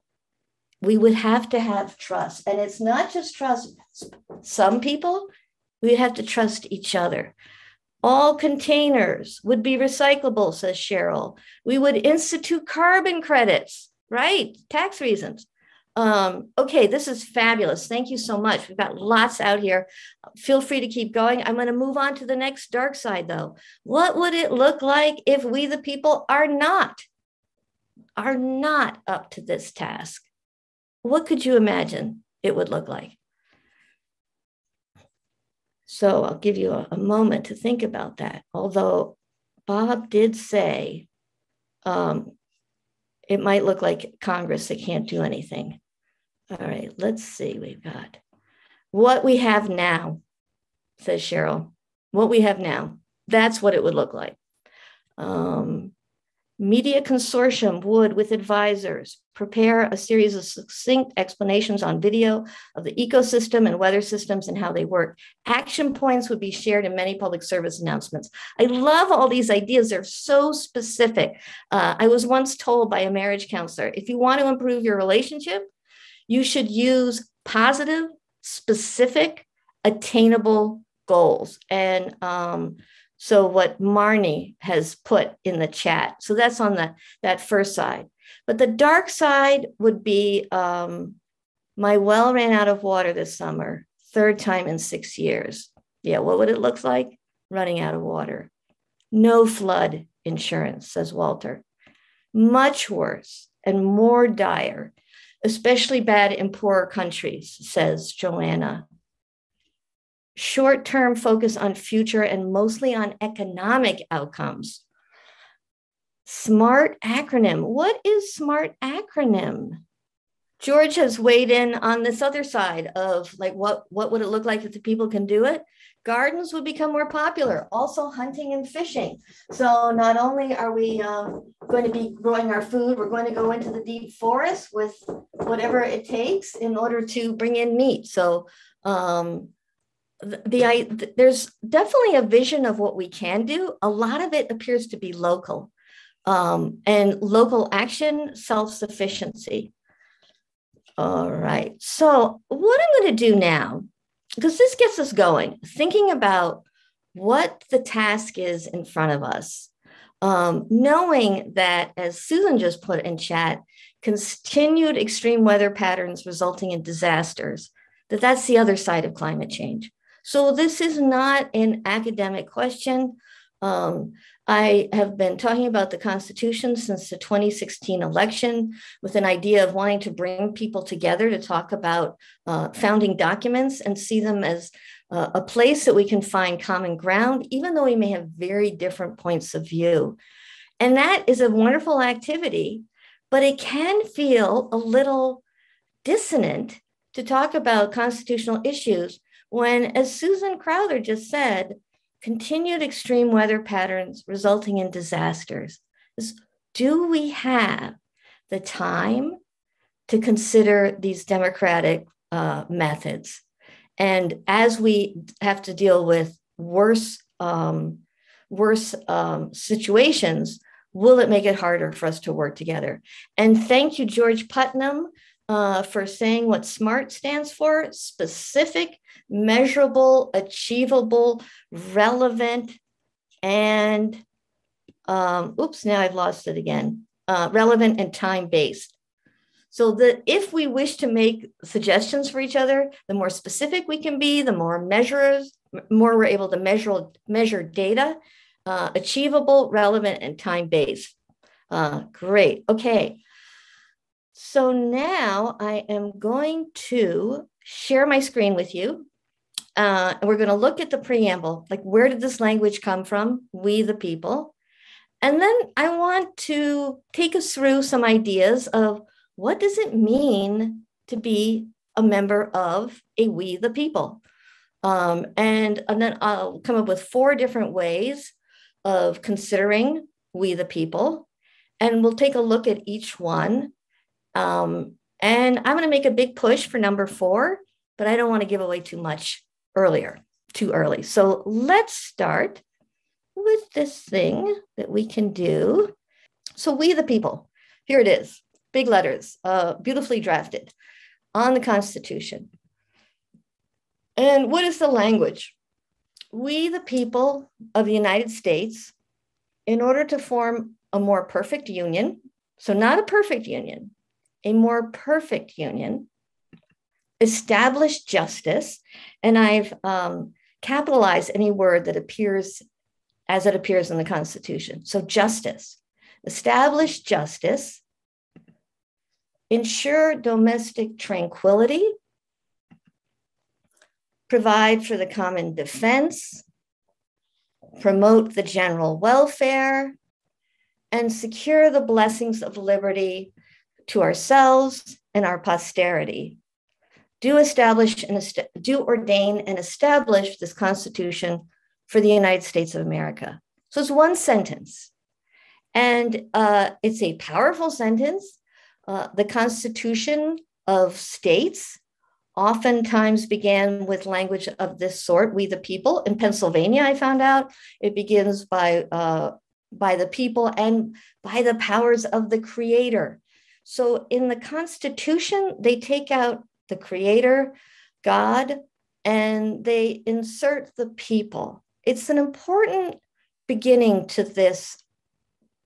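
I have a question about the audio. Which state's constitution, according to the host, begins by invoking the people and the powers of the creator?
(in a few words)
Pennsylvania.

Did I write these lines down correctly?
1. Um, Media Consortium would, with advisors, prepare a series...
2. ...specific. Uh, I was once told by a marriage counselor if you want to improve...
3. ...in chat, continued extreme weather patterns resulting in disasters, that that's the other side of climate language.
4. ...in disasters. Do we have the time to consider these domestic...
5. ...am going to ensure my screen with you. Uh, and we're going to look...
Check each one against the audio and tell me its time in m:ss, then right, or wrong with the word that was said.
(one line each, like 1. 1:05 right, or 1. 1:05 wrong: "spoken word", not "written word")
1. 0:55 right
2. 1:10 right
3. 2:43 wrong: "change", not "language"
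4. 3:24 wrong: "democratic", not "domestic"
5. 4:15 wrong: "share", not "ensure".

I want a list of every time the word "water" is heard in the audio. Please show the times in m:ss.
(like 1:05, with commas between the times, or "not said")
1:32, 1:38.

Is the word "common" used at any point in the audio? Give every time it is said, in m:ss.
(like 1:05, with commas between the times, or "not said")
3:06, 5:35.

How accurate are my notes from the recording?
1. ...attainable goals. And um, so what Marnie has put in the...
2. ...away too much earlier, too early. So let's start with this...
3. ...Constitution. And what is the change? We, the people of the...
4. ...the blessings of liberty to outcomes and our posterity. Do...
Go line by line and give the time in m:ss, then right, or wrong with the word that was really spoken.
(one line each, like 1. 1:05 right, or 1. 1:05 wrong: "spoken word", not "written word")
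1. 1:19 right
2. 4:48 right
3. 5:01 wrong: "language", not "change"
4. 5:41 wrong: "ourselves", not "outcomes".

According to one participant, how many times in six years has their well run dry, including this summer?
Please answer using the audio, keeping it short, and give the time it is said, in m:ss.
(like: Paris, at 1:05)
3, at 1:34.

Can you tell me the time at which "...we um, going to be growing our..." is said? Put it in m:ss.
2:10.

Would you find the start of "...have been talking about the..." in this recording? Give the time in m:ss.
2:54.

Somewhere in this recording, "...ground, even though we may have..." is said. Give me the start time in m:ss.
3:06.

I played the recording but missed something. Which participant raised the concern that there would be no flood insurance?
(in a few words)
Walter.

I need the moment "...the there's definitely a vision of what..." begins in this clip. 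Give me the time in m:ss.
2:20.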